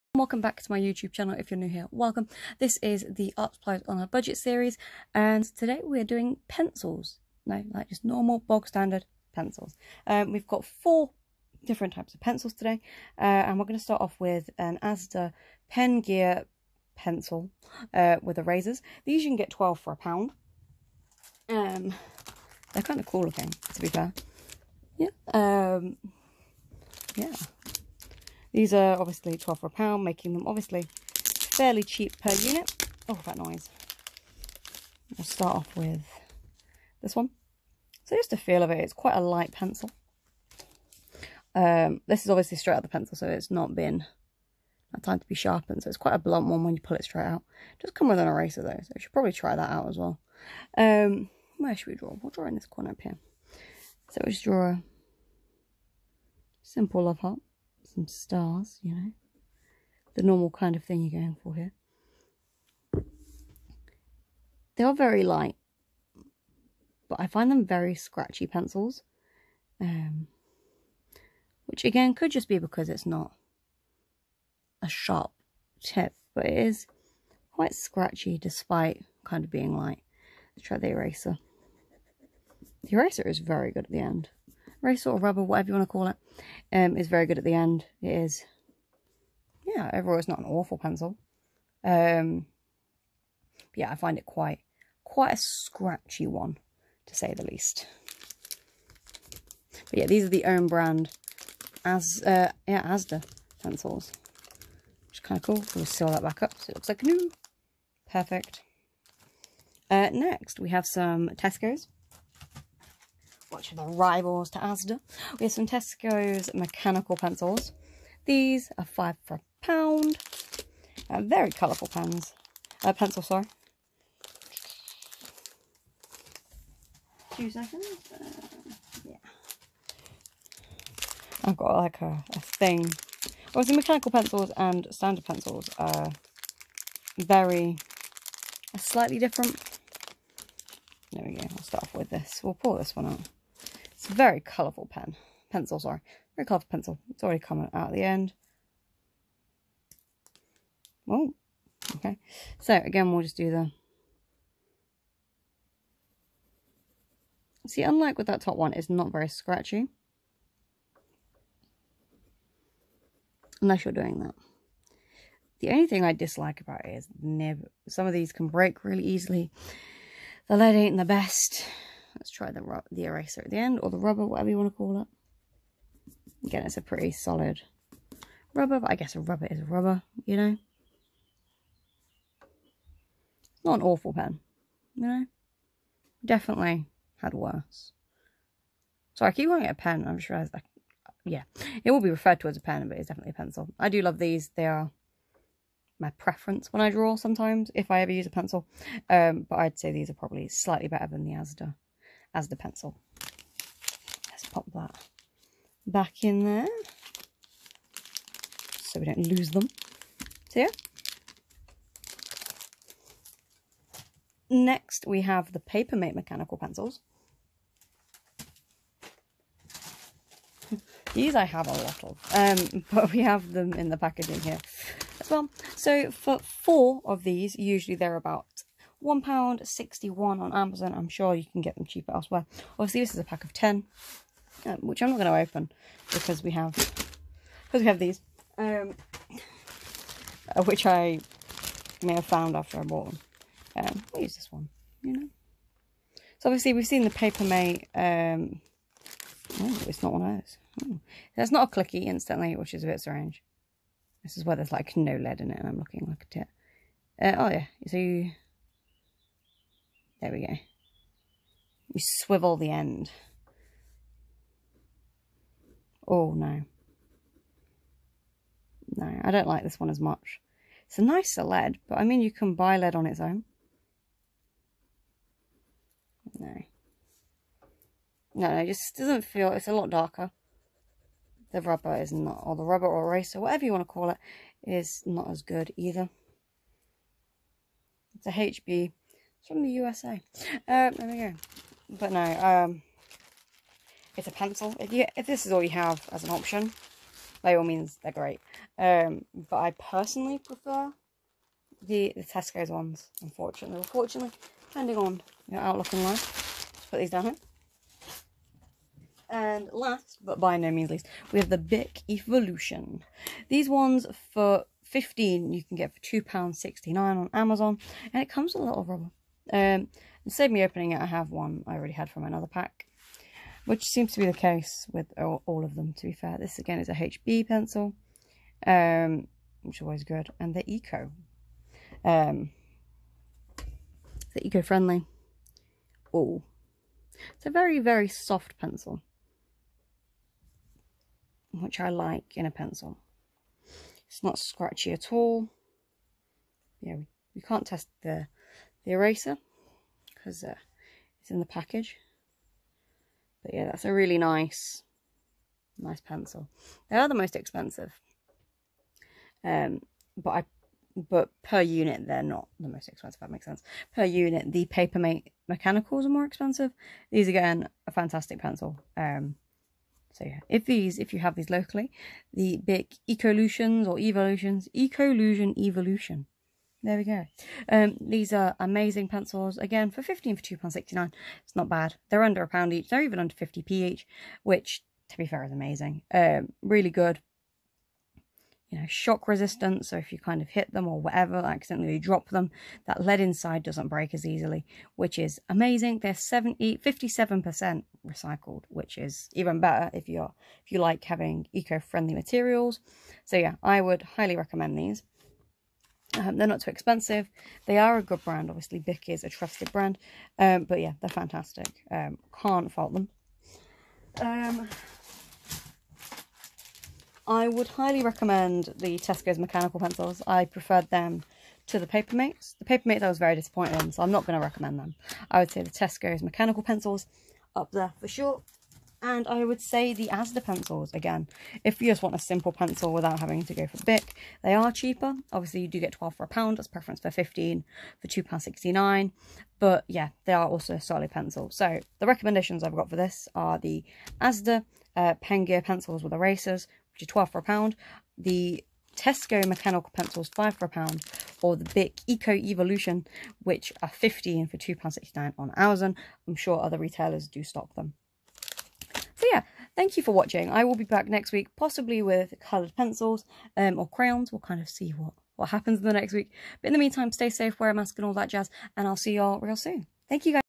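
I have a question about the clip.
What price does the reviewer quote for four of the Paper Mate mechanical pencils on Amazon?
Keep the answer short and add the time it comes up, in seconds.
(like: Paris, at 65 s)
£1.61, at 229 s.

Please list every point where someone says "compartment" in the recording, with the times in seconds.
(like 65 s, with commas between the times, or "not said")
not said.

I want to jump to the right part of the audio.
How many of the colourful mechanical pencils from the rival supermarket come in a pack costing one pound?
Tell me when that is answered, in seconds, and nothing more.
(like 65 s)
118 s.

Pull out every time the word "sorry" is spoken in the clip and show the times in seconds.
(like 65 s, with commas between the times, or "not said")
123 s, 145 s.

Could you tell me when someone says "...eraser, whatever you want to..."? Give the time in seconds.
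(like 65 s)
283 s.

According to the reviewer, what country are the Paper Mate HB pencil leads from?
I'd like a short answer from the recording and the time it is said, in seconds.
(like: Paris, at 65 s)
USA, at 289 s.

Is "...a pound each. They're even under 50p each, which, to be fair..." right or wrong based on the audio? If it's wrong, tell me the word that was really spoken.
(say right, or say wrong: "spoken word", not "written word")
right.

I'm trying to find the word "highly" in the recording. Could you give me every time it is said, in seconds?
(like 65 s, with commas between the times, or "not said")
404 s, 417 s.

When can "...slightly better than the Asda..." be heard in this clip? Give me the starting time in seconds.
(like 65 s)
200 s.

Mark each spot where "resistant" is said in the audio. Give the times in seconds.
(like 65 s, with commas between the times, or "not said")
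389 s.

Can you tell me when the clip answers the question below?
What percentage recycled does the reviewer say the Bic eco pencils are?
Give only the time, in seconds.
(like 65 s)
396 s.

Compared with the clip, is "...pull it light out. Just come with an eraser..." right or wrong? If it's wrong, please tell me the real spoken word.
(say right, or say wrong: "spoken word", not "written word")
wrong: "straight", not "light".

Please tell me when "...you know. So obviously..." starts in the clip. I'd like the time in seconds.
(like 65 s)
245 s.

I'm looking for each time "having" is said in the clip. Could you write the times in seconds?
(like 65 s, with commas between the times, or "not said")
401 s, 433 s.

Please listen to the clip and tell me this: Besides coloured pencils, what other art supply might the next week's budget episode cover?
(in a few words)
crayons.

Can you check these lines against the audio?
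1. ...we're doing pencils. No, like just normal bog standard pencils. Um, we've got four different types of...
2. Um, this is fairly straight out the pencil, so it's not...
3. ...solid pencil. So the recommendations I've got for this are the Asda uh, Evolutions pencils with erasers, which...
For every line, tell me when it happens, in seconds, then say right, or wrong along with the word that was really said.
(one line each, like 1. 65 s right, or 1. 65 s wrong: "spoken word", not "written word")
1. 5 s right
2. 41 s wrong: "obviously", not "fairly"
3. 440 s wrong: "Gear", not "Evolutions".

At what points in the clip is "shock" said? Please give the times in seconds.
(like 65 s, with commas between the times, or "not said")
388 s.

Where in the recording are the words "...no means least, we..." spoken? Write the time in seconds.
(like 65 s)
310 s.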